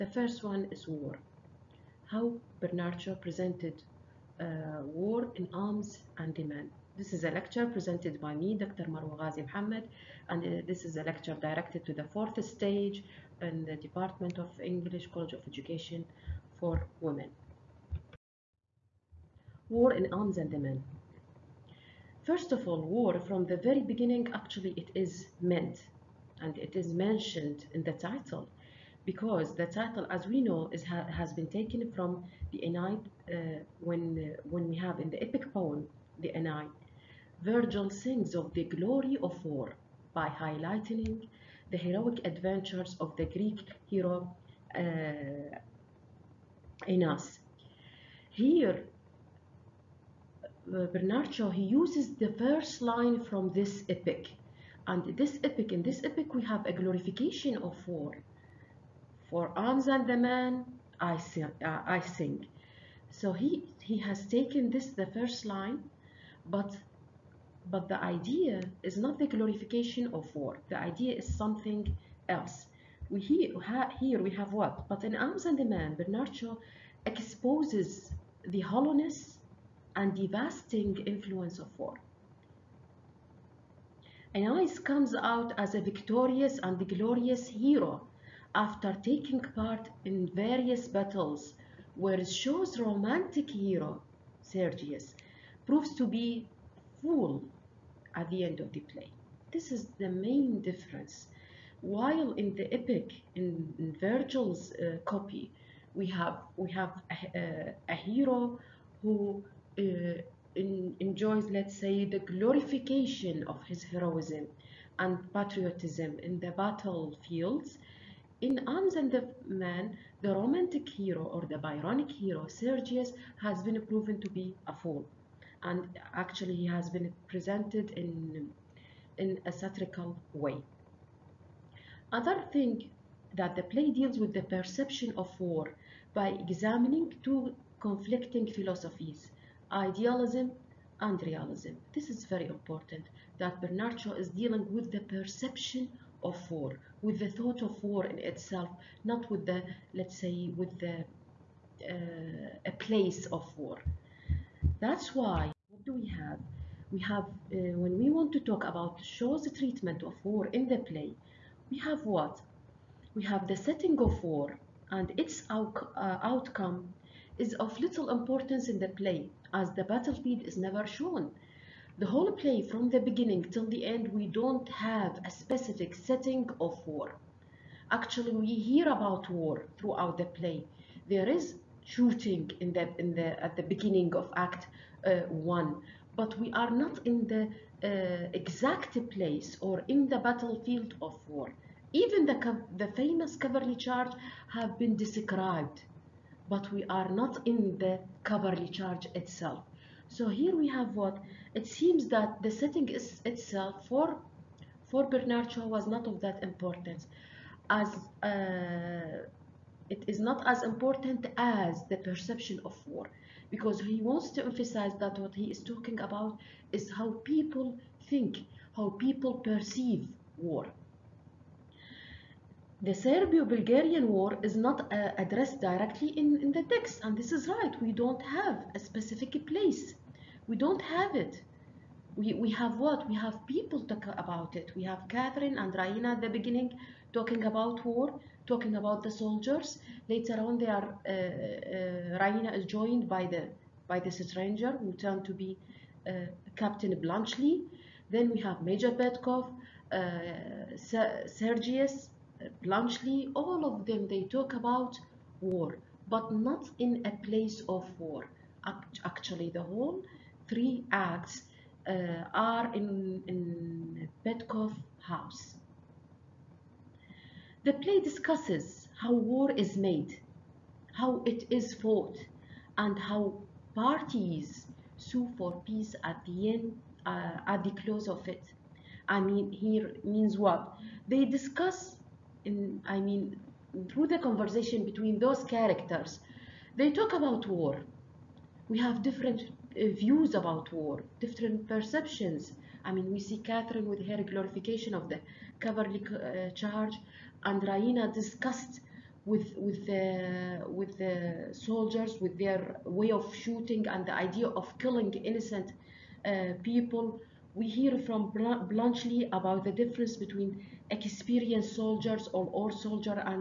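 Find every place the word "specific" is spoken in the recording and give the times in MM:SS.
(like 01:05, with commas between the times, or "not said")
02:55, 03:48.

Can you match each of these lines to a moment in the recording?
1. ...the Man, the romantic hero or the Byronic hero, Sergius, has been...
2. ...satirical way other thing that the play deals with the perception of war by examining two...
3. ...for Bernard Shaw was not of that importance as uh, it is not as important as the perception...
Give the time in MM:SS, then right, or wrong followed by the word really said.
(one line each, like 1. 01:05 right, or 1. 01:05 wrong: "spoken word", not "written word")
1. 01:59 right
2. 02:09 right
3. 03:24 right.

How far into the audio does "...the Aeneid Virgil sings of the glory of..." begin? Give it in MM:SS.
00:36.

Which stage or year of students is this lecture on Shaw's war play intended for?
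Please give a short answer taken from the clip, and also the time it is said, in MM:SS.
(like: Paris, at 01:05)
fourth stage, at 00:12.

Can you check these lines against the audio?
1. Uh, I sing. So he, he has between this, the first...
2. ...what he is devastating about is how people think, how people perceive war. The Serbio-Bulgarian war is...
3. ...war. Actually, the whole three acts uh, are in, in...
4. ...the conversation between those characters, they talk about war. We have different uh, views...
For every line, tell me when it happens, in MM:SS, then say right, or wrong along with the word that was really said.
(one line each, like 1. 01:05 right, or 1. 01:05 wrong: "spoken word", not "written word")
1. 01:01 wrong: "taken", not "between"
2. 03:35 wrong: "talking", not "devastating"
3. 04:17 right
4. 04:44 right.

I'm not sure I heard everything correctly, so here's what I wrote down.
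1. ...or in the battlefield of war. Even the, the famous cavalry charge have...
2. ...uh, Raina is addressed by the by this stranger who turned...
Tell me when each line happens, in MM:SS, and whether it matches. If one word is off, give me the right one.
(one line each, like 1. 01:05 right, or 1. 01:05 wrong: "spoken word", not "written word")
1. 03:09 right
2. 04:01 wrong: "joined", not "addressed".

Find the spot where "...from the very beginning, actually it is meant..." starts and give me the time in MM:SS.
00:23.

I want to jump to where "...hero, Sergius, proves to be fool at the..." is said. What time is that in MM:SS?
01:33.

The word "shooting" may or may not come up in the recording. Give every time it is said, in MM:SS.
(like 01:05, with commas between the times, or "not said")
03:01, 05:03.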